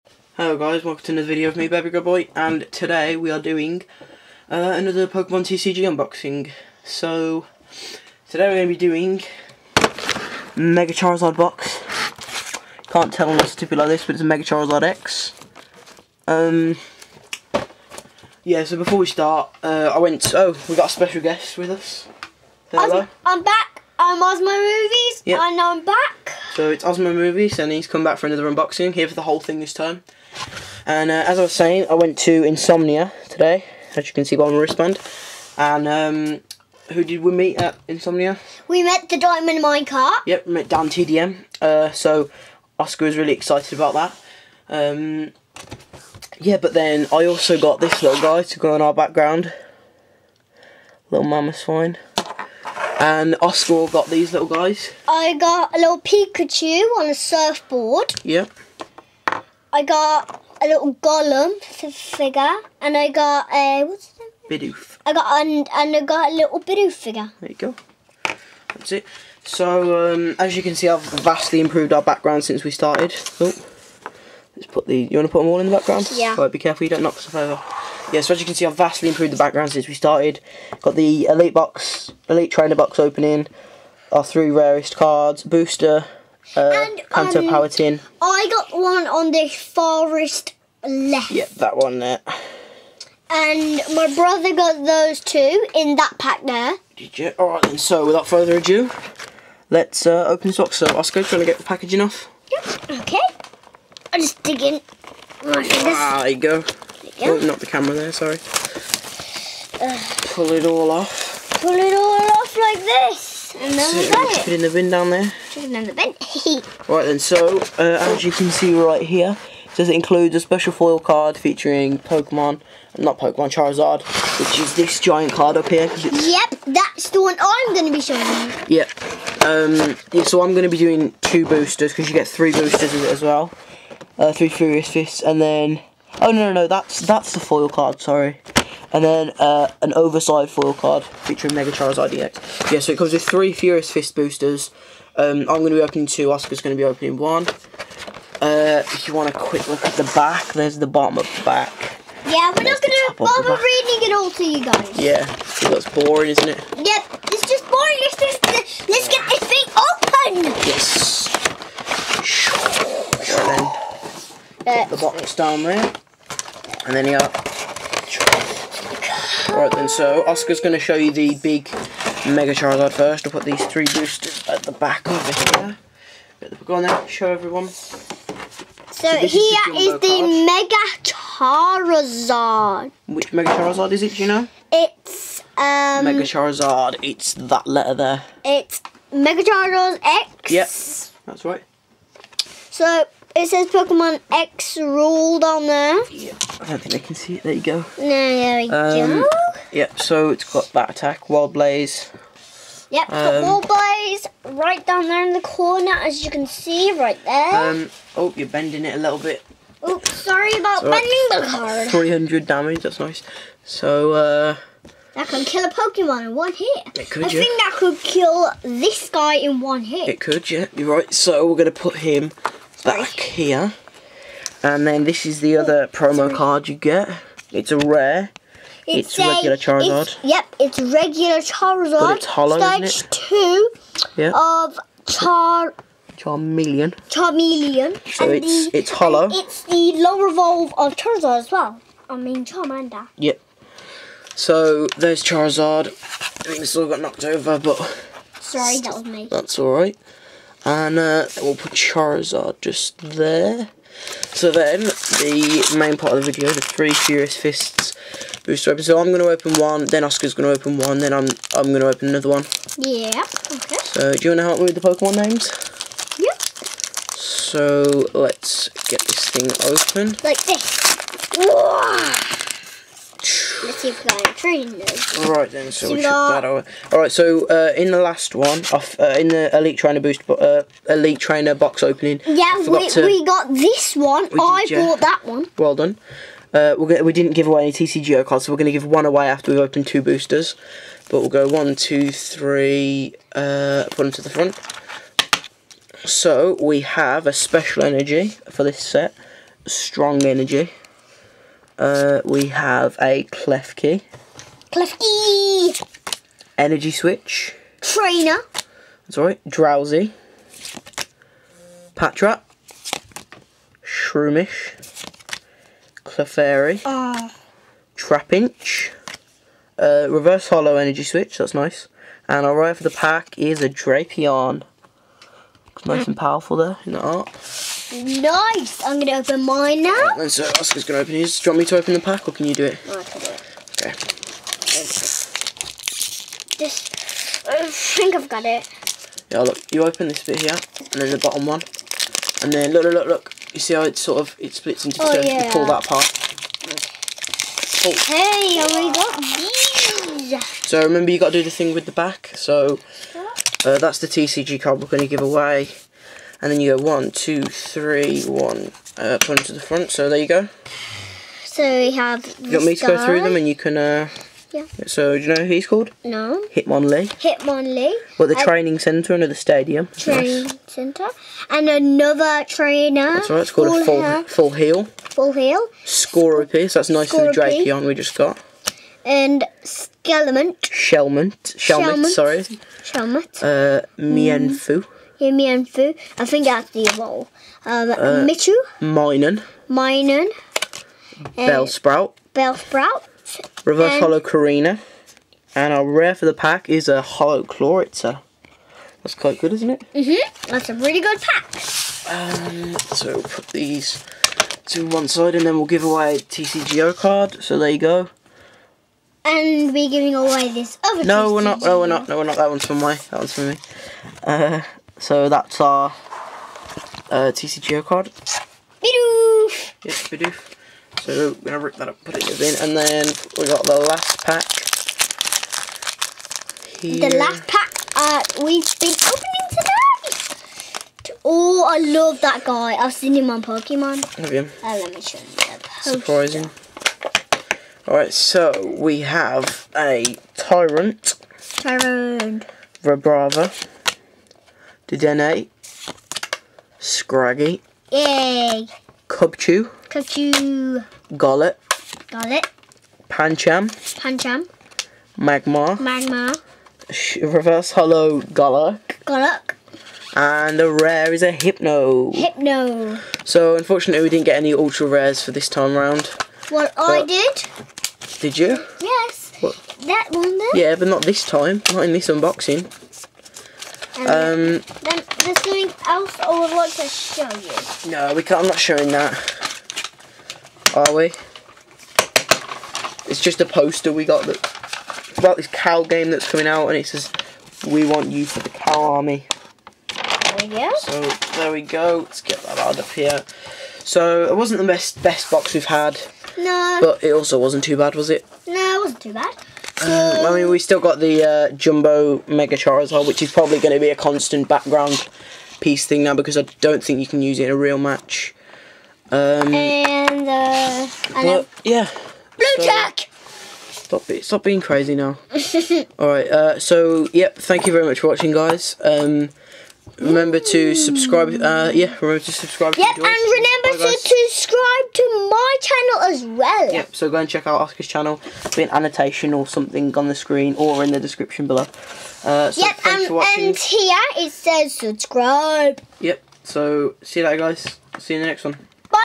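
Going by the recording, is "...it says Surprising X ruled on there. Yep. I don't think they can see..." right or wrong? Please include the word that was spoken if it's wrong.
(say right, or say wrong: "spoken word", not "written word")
wrong: "Pokemon", not "Surprising".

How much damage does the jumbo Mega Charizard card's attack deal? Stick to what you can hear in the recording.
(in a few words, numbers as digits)
300.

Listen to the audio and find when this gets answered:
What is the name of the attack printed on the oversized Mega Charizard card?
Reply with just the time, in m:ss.
3:21.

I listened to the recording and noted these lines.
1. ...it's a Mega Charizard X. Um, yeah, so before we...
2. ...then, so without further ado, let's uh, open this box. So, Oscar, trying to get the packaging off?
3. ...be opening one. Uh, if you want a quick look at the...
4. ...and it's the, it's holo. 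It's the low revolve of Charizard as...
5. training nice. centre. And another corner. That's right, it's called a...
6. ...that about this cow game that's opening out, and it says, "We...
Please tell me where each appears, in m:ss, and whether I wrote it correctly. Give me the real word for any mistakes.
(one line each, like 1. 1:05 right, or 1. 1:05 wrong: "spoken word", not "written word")
1. 0:14 right
2. 1:37 right
3. 2:26 right
4. 3:58 right
5. 6:09 wrong: "trainer", not "corner"
6. 8:04 wrong: "coming", not "opening".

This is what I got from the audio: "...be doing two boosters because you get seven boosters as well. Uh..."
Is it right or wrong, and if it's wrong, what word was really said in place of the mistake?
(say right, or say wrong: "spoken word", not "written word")
wrong: "three", not "seven".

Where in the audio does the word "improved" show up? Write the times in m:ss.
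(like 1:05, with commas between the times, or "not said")
1:11, 1:19.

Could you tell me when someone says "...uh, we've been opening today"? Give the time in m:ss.
7:07.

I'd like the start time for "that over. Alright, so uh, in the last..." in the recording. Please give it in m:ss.
4:36.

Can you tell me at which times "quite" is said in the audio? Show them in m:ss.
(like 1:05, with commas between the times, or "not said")
6:39.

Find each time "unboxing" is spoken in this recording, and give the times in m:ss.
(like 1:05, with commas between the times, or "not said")
0:05, 0:28, 7:52.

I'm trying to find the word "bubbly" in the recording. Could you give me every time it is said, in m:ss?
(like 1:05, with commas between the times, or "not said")
not said.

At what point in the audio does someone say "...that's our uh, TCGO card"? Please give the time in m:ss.
6:55.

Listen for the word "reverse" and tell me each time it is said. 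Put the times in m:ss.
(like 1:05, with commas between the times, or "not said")
5:20, 6:33, 7:37.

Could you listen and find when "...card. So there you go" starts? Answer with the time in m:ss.
6:46.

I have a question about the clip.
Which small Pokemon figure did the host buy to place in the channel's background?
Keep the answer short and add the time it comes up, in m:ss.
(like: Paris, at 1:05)
Mamoswine, at 0:51.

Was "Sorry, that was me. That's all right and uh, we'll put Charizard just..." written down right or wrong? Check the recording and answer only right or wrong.
right.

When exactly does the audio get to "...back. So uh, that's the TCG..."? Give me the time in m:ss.
5:51.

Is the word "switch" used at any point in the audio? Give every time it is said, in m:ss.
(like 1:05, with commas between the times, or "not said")
5:06, 5:21.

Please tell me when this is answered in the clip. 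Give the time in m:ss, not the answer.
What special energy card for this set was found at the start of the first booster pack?
4:59.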